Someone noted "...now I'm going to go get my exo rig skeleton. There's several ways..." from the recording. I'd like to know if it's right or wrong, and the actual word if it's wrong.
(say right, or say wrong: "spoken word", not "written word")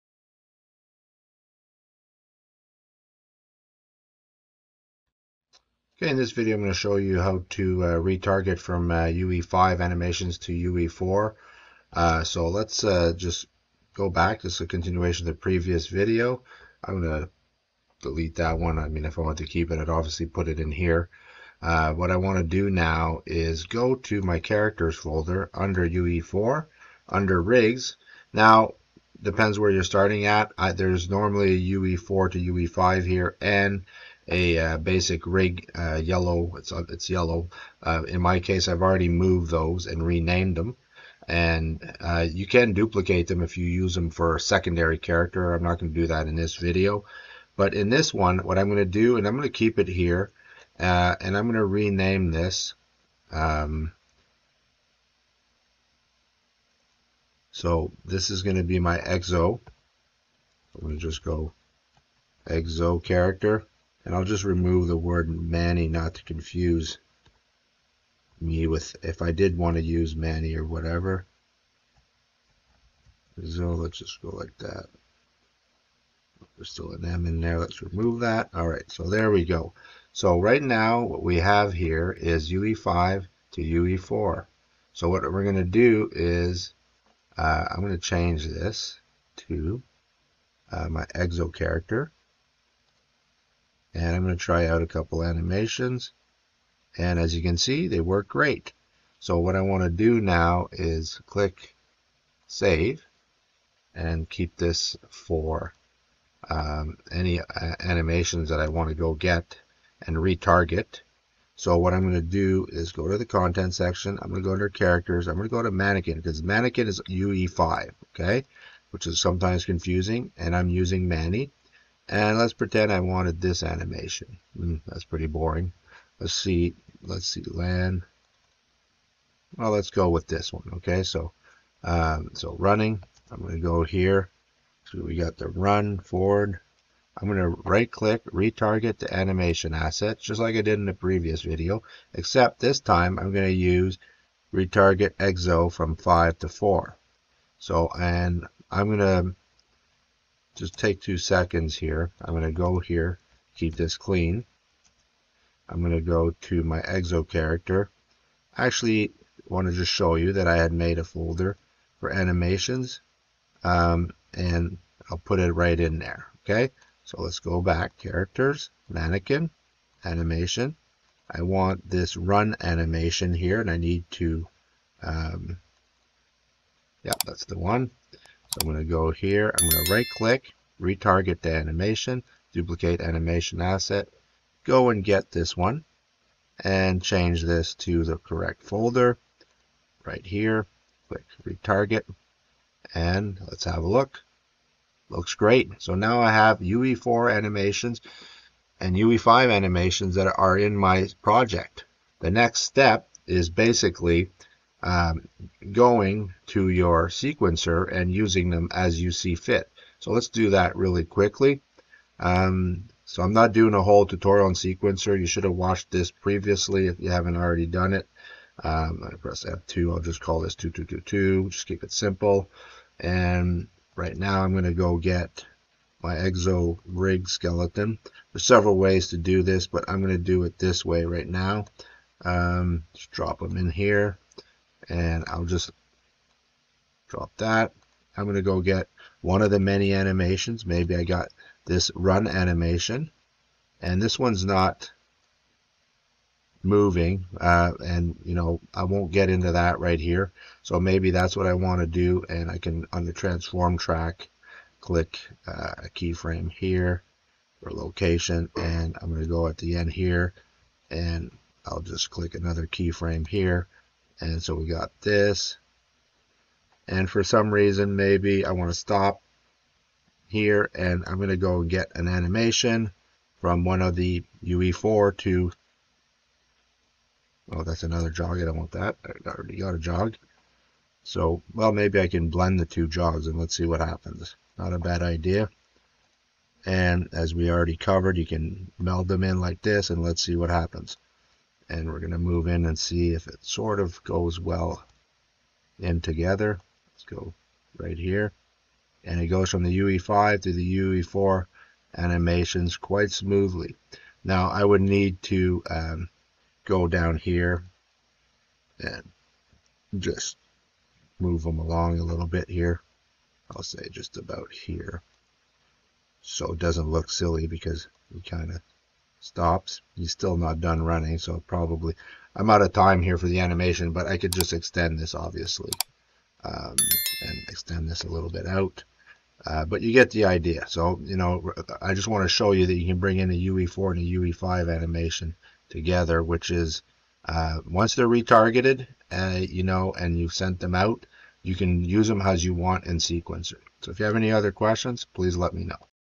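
right.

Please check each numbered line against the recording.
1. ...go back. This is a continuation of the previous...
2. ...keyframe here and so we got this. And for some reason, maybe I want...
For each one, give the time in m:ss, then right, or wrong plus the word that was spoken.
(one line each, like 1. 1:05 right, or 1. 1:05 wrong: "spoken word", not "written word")
1. 0:13 right
2. 4:22 right.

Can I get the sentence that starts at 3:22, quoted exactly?
The next step is basically um, going to your sequencer and using them as you see fit.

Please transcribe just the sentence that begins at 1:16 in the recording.
There's still an M in there.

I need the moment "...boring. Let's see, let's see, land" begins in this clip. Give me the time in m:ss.
2:05.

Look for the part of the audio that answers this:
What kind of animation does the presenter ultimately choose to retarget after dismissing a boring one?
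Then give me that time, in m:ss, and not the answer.
2:15.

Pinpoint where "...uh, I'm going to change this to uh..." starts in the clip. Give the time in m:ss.
1:27.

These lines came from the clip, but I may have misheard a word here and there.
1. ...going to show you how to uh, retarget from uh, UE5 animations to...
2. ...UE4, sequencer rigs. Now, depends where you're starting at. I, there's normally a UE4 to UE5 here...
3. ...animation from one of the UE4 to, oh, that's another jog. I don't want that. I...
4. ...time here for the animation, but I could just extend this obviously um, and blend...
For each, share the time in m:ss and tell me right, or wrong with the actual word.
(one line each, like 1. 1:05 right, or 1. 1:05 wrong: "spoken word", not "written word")
1. 0:06 right
2. 0:25 wrong: "under", not "sequencer"
3. 4:32 right
4. 5:22 wrong: "extend", not "blend".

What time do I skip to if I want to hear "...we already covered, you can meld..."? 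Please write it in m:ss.
4:47.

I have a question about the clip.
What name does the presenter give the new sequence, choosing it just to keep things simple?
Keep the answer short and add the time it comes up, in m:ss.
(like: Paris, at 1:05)
2222, at 3:40.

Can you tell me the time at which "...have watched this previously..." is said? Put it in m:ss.
3:35.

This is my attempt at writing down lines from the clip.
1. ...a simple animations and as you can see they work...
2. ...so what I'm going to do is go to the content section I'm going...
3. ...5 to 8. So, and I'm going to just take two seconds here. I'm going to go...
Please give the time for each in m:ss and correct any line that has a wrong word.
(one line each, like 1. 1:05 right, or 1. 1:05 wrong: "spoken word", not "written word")
1. 1:34 wrong: "couple", not "simple"
2. 1:51 right
3. 2:25 wrong: "4", not "8".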